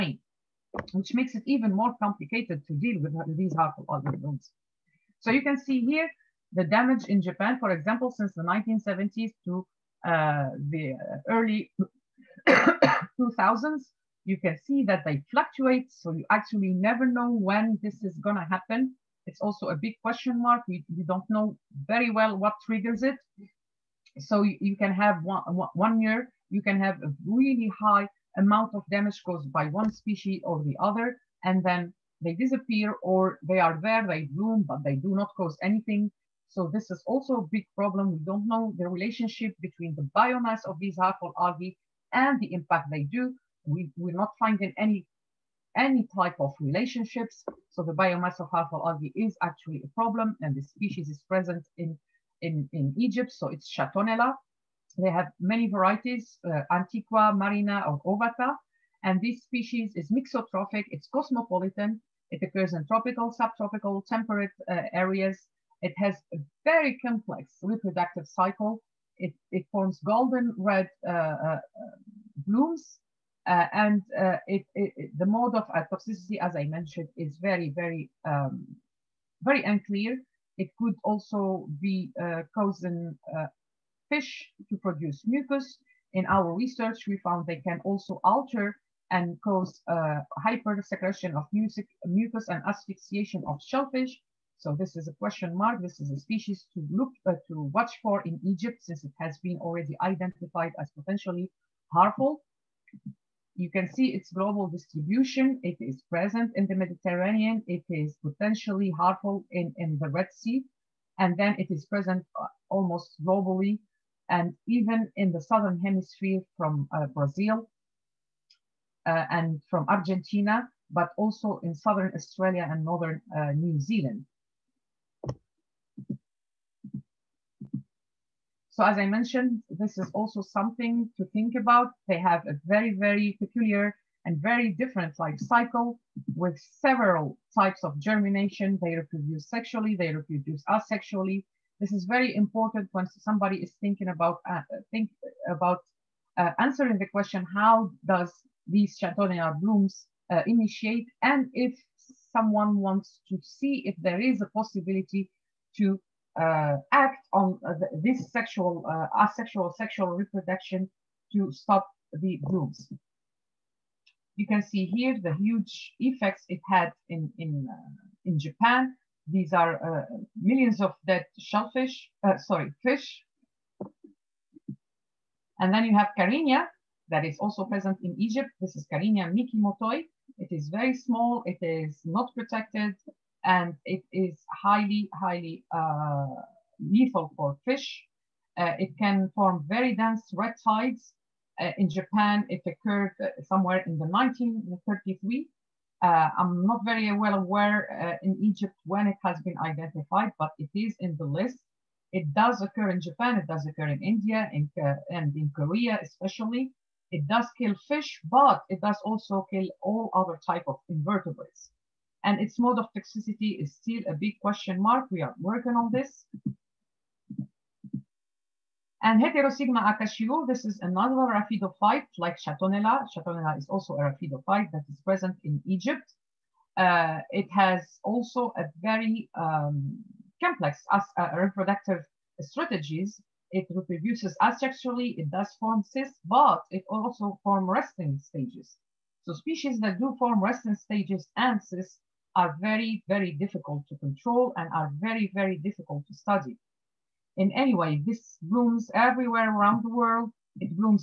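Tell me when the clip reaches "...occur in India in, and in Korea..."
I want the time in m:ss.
3:23.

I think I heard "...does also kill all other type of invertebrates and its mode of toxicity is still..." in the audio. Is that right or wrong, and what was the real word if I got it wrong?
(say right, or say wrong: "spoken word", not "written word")
right.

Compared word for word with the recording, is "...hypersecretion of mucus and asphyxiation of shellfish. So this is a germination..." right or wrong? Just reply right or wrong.
wrong.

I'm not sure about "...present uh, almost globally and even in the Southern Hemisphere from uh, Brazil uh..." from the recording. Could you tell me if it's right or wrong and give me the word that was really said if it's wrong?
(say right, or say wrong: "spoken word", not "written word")
right.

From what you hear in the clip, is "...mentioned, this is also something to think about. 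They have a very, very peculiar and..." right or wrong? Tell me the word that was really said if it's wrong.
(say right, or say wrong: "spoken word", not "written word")
right.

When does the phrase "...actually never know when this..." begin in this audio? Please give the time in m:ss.
0:16.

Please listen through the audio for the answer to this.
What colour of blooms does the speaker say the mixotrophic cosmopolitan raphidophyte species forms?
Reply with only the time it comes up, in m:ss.
1:10.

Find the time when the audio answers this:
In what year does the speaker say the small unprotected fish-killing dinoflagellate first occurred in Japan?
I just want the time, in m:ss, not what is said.
3:14.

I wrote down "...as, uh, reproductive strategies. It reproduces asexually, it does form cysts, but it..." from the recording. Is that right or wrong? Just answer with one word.
right.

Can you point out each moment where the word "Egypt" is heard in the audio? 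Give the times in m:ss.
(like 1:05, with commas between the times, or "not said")
0:52, 1:38, 2:58, 3:18, 3:45.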